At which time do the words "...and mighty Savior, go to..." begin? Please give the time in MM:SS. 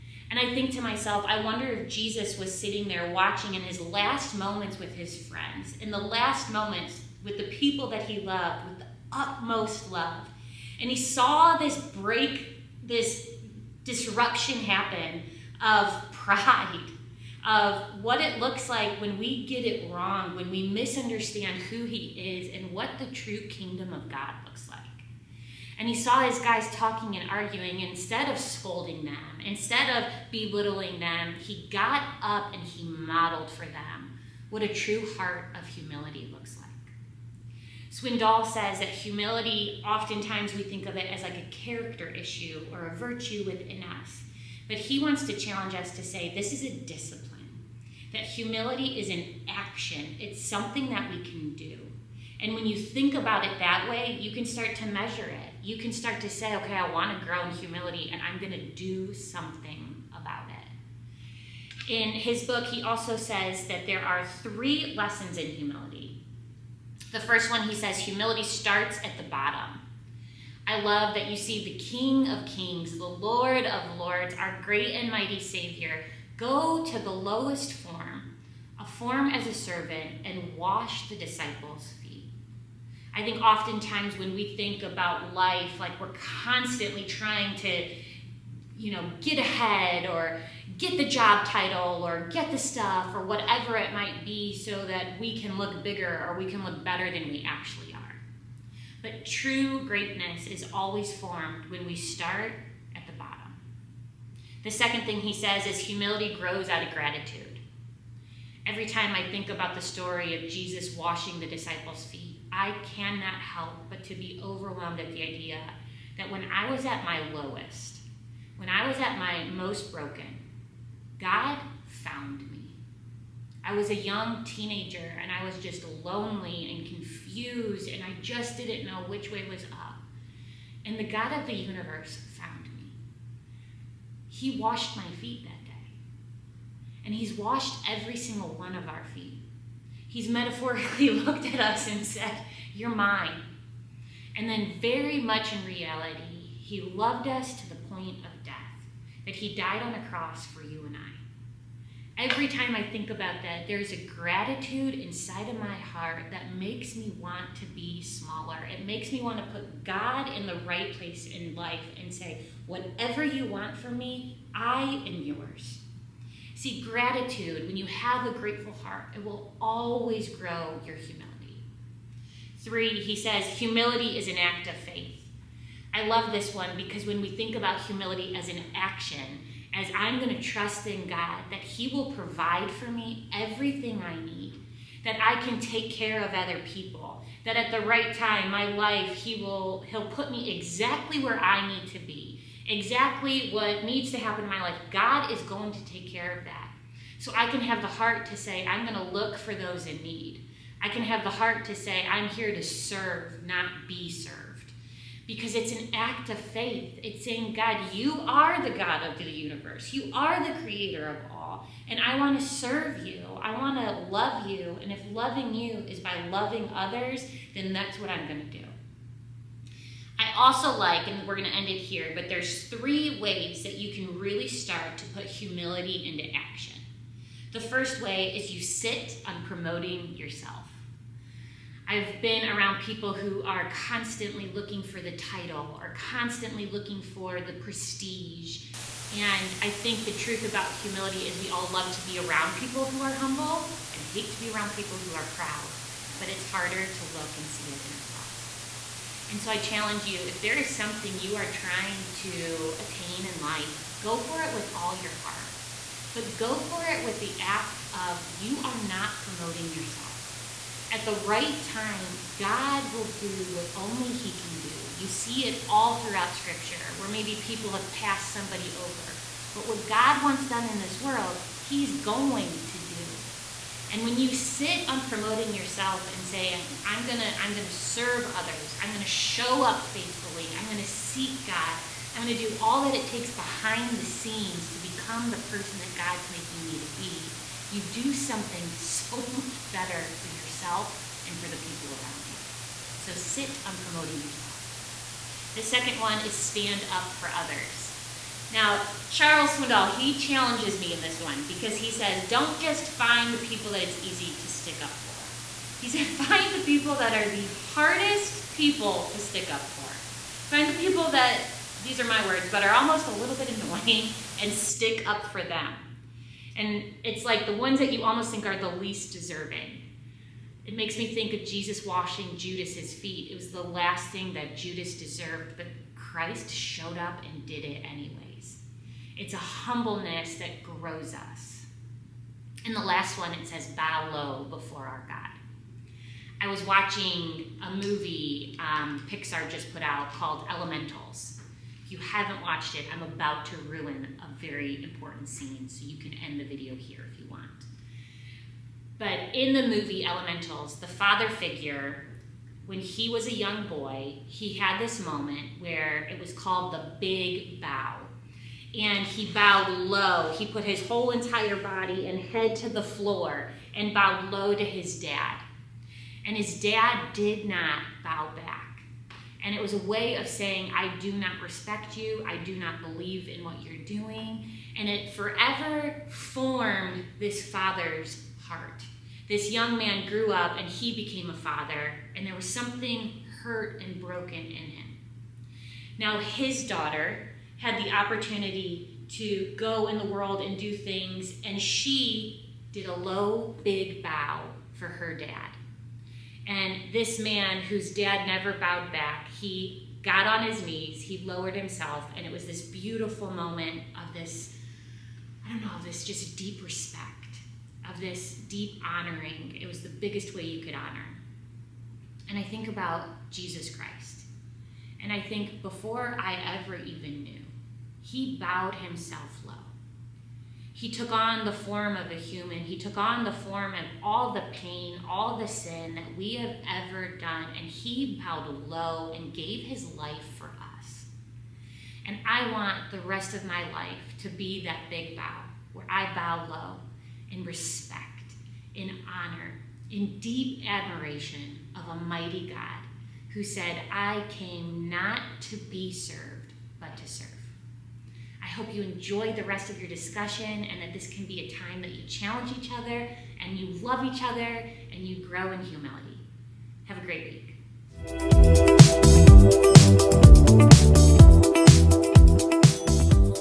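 01:14.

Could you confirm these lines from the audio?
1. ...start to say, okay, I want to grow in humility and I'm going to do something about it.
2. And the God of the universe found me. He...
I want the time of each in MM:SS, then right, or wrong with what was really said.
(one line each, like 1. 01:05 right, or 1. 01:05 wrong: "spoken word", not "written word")
1. 00:55 right
2. 02:10 right.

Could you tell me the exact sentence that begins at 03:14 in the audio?
God is going to take care of that.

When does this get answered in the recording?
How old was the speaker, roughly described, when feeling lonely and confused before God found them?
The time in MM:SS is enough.
02:03.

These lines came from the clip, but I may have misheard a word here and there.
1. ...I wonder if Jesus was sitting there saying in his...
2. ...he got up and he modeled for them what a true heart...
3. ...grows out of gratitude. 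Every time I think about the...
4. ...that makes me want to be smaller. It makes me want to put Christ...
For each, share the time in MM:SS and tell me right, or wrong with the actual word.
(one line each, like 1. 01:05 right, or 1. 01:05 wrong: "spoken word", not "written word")
1. 00:01 wrong: "watching", not "saying"
2. 00:31 right
3. 01:46 right
4. 02:36 wrong: "God", not "Christ".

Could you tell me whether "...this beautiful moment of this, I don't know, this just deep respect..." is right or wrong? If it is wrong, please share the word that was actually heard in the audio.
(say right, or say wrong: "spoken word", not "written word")
right.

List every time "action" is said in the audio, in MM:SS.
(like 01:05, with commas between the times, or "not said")
00:49, 02:58, 03:46.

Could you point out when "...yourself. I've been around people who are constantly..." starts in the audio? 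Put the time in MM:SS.
03:50.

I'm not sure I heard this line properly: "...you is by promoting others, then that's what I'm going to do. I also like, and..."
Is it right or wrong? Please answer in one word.
wrong.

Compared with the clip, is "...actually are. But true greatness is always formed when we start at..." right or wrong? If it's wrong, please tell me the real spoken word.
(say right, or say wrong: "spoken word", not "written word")
right.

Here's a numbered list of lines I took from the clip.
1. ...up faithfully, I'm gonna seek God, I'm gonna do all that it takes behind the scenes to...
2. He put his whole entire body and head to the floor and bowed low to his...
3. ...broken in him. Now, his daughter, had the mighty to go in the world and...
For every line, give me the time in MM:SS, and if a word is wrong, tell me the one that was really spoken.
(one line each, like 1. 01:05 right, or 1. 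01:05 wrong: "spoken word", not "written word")
1. 04:39 right
2. 06:00 right
3. 06:24 wrong: "opportunity", not "mighty".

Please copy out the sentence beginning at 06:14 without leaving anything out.
And it forever formed this father's heart.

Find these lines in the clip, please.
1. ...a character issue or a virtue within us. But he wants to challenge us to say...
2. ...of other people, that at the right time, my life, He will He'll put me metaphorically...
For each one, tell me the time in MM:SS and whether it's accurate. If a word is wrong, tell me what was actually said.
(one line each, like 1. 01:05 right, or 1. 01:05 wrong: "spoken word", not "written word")
1. 00:41 right
2. 03:06 wrong: "exactly", not "metaphorically".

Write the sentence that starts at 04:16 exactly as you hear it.
But go for it with the act of you are not promoting yourself.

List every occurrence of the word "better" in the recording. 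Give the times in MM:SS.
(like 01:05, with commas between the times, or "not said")
01:36, 04:49.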